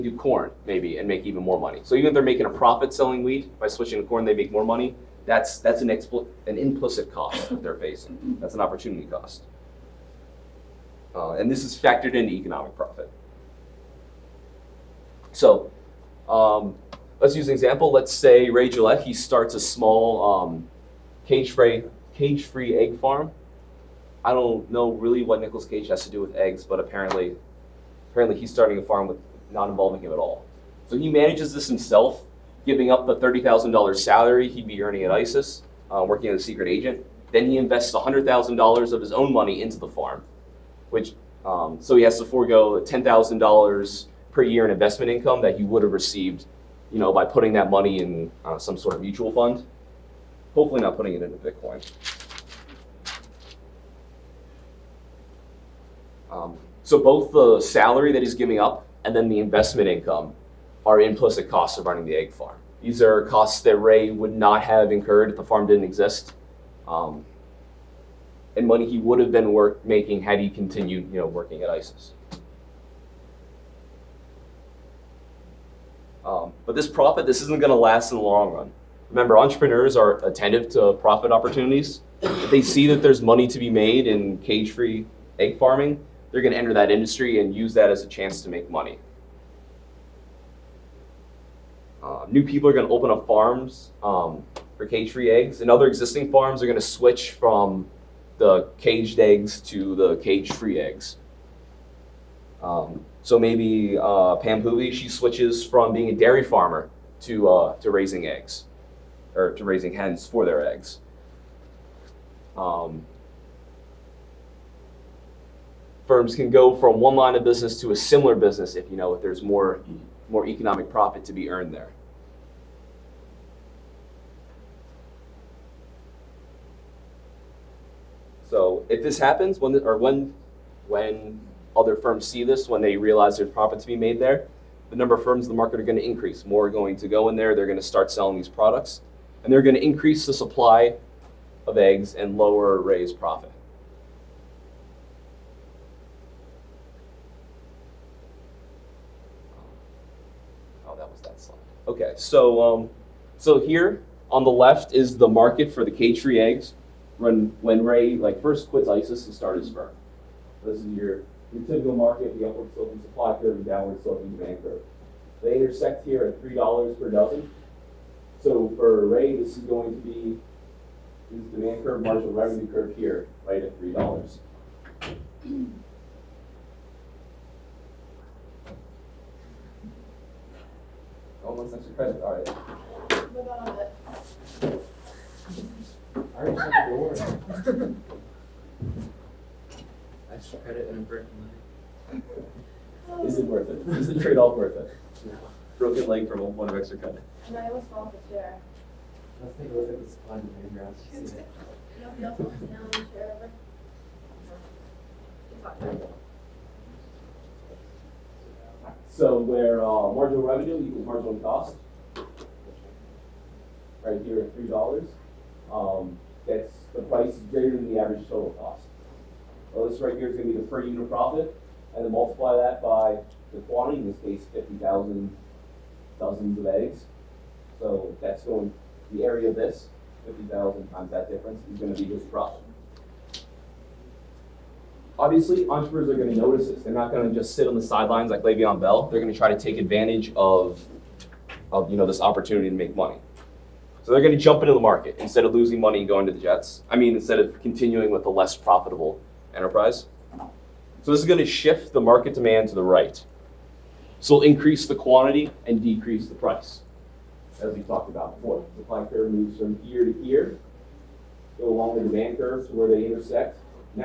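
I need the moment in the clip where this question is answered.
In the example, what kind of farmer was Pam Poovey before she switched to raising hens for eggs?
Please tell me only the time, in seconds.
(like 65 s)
106 s.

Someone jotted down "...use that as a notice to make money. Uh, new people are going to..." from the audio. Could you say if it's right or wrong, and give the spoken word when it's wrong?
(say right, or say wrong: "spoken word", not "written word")
wrong: "chance", not "notice".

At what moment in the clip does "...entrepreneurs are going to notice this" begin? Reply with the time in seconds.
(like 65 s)
235 s.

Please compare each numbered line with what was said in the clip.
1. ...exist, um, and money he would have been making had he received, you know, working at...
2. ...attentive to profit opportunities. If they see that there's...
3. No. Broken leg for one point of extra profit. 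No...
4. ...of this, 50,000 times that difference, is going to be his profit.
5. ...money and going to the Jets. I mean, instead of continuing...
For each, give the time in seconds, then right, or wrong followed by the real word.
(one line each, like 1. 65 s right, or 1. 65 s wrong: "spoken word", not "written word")
1. 65 s wrong: "continued", not "received"
2. 80 s right
3. 195 s wrong: "credit", not "profit"
4. 229 s right
5. 245 s right.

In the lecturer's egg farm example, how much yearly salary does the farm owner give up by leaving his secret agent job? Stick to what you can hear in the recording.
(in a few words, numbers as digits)
$30,000.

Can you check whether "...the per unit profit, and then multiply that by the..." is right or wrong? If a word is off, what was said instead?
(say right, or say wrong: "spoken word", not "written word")
right.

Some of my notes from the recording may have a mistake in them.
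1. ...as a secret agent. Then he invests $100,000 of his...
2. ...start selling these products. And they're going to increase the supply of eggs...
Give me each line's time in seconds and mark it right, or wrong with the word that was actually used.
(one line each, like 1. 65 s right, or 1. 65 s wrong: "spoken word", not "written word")
1. 36 s right
2. 137 s right.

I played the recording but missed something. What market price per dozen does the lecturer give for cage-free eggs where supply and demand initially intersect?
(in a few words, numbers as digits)
$3 per dozen.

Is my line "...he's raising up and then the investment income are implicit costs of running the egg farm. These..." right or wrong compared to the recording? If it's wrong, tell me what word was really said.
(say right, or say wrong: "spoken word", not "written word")
wrong: "giving", not "raising".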